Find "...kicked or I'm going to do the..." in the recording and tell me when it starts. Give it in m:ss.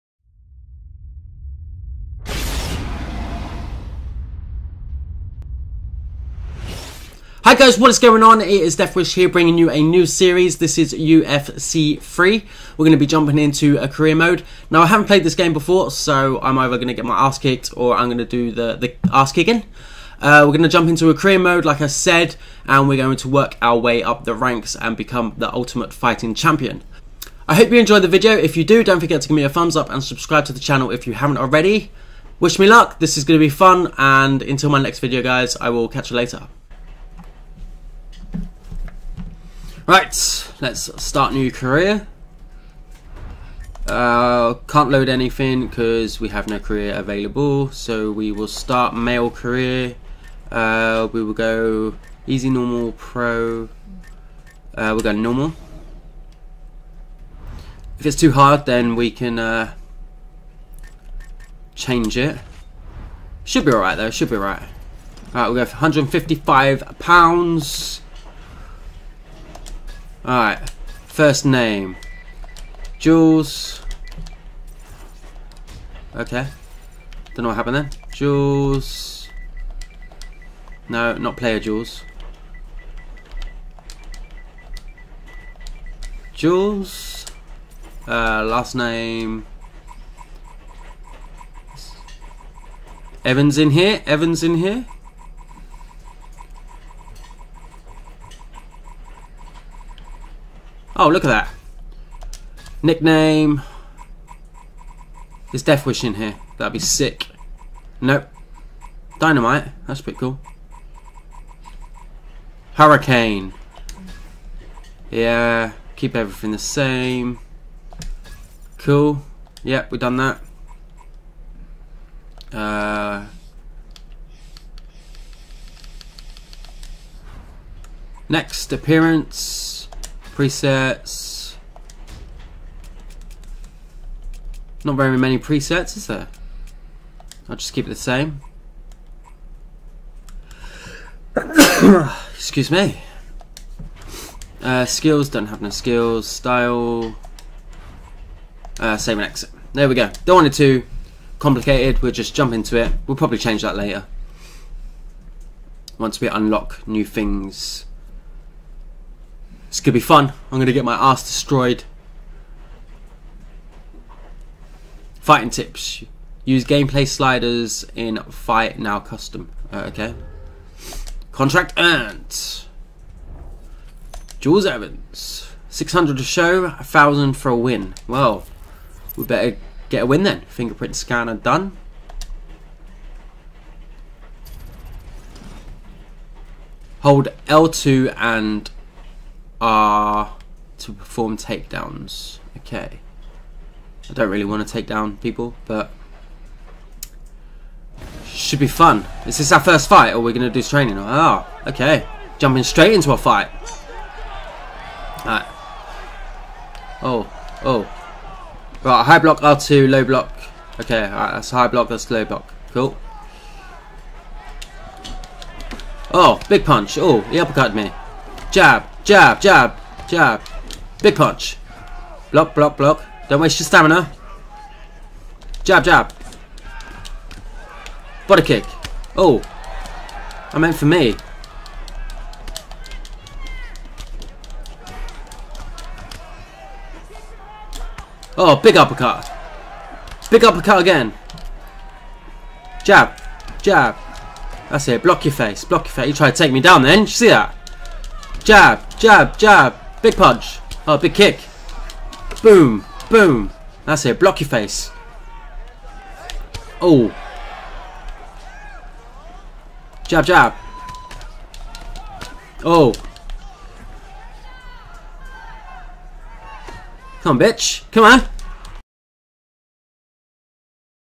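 0:17.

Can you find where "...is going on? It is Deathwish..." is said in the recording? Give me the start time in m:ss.
0:07.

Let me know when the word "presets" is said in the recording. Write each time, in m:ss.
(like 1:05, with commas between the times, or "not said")
2:10, 2:15.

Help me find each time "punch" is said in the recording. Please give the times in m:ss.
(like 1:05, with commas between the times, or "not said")
3:36, 3:41, 4:10.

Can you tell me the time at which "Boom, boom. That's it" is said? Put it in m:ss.
4:12.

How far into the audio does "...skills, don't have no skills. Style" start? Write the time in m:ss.
2:24.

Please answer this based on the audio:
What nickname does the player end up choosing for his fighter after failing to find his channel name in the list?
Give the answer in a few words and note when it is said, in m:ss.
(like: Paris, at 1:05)
Dynamite, at 1:49.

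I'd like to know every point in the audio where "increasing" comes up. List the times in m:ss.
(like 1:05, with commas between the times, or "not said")
not said.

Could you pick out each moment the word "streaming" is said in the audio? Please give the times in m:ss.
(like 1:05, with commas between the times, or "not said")
not said.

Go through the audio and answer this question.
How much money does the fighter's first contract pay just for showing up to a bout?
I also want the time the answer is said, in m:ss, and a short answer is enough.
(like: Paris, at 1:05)
600, at 2:55.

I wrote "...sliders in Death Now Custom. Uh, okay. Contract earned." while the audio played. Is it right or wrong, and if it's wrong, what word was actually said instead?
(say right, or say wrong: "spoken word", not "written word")
wrong: "Fight", not "Death".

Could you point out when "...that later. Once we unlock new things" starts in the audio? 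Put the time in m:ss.
2:33.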